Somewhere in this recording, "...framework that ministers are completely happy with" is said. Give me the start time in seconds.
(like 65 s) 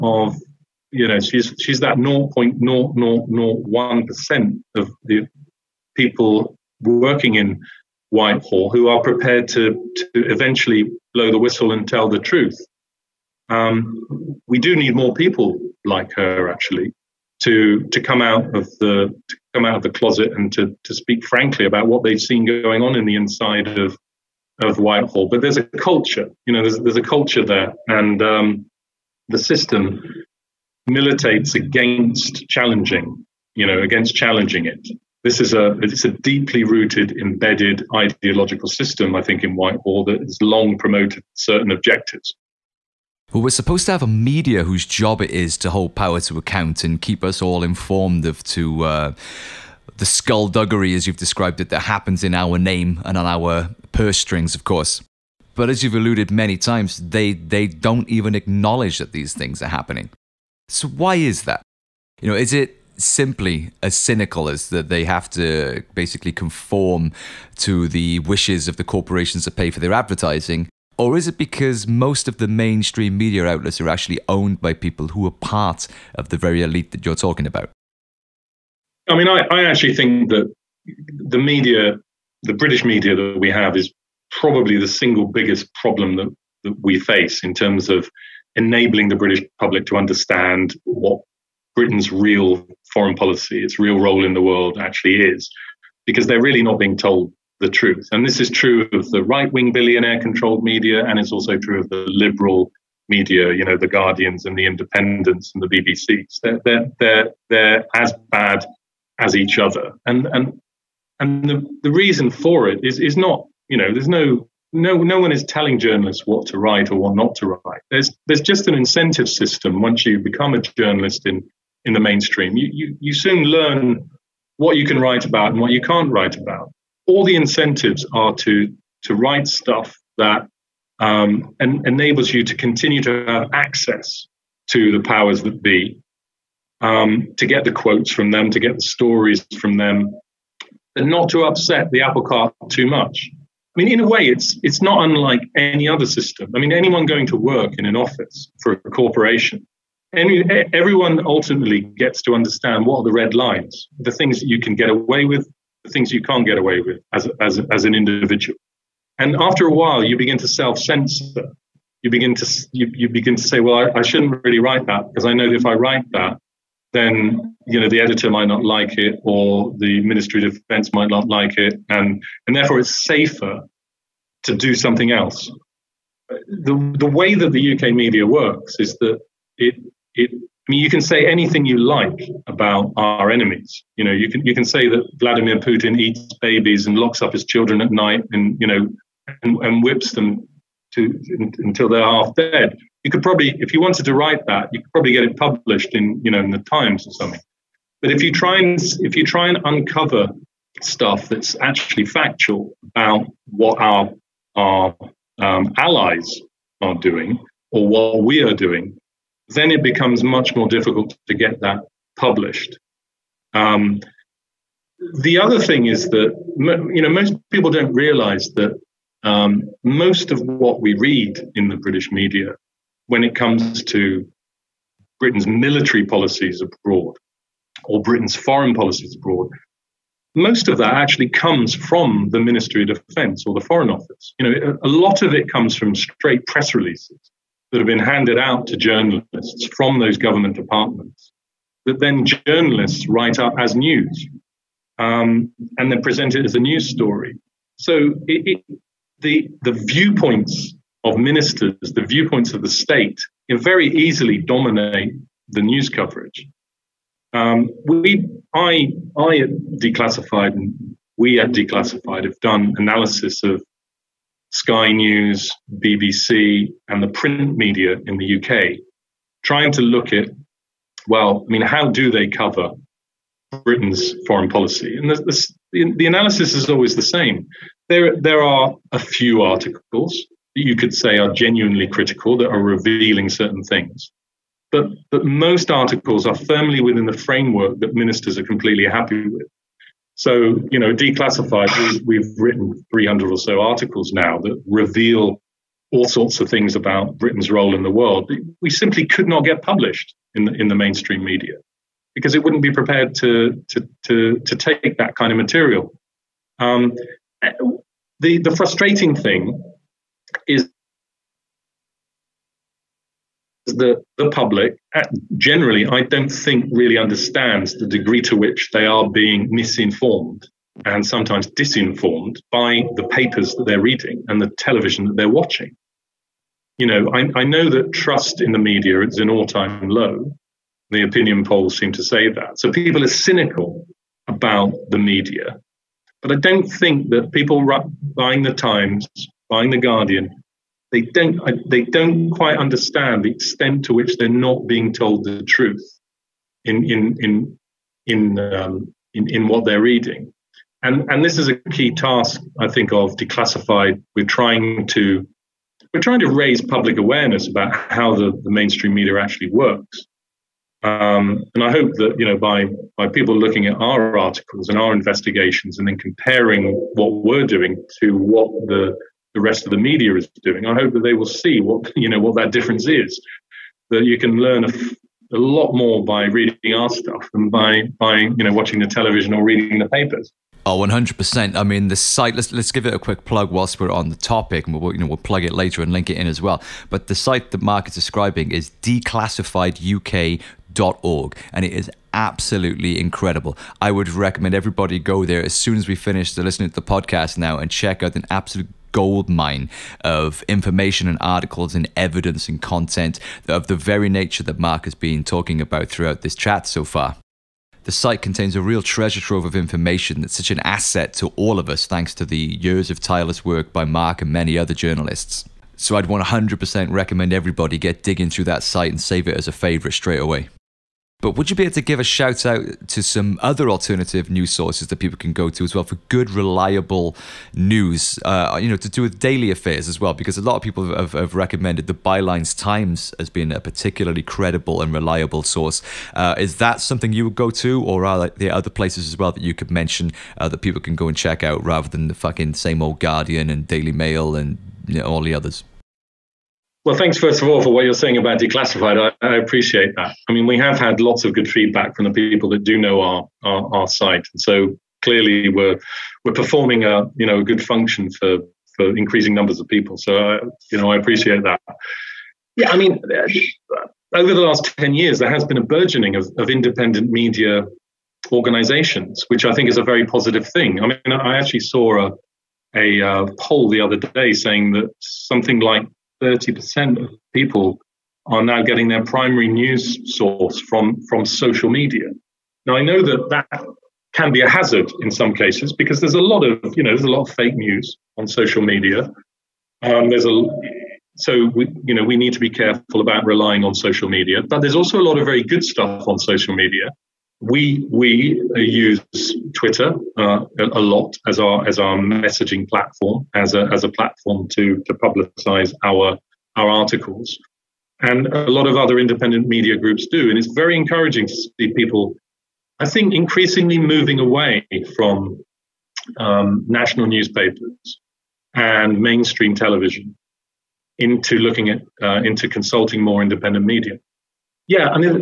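287 s.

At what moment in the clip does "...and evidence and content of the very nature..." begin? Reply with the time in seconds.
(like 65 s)
401 s.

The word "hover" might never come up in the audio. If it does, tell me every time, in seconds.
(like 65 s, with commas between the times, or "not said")
not said.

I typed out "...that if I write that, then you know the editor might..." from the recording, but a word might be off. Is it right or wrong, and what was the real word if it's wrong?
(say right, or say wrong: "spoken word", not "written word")
right.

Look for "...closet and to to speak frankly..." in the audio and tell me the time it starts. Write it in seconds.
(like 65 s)
19 s.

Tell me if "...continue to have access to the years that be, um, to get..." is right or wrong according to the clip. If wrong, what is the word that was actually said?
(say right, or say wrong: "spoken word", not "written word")
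wrong: "powers", not "years".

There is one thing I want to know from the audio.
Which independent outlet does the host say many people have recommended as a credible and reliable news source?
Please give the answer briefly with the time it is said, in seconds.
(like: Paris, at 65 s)
Bylines Times, at 431 s.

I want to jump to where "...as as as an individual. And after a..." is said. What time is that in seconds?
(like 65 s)
157 s.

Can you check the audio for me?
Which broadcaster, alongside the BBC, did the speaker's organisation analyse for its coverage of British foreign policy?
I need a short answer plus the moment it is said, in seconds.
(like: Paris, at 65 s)
Sky News, at 264 s.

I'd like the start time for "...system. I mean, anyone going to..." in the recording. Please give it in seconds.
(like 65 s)
146 s.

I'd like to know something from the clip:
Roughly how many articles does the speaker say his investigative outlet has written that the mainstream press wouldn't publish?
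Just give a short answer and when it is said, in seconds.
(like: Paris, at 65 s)
300, at 292 s.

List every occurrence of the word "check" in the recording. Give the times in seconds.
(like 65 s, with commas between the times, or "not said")
397 s, 441 s.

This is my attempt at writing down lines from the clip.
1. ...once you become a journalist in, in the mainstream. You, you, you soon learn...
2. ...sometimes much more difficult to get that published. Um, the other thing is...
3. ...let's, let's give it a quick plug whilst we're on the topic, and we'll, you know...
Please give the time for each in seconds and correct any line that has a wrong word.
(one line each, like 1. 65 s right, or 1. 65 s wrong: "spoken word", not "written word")
1. 119 s right
2. 209 s wrong: "becomes", not "sometimes"
3. 382 s right.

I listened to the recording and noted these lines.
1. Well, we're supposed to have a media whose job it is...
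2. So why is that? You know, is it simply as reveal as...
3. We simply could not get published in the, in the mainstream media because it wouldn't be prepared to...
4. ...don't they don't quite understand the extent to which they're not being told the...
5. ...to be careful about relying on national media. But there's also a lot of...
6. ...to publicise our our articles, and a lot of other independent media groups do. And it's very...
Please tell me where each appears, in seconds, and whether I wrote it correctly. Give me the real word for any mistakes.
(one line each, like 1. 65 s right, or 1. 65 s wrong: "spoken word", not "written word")
1. 43 s right
2. 60 s wrong: "cynical", not "reveal"
3. 298 s right
4. 341 s right
5. 492 s wrong: "social", not "national"
6. 504 s right.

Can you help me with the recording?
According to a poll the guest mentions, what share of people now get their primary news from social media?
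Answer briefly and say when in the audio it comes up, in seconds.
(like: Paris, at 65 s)
30%, at 476 s.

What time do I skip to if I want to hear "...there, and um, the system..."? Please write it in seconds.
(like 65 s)
27 s.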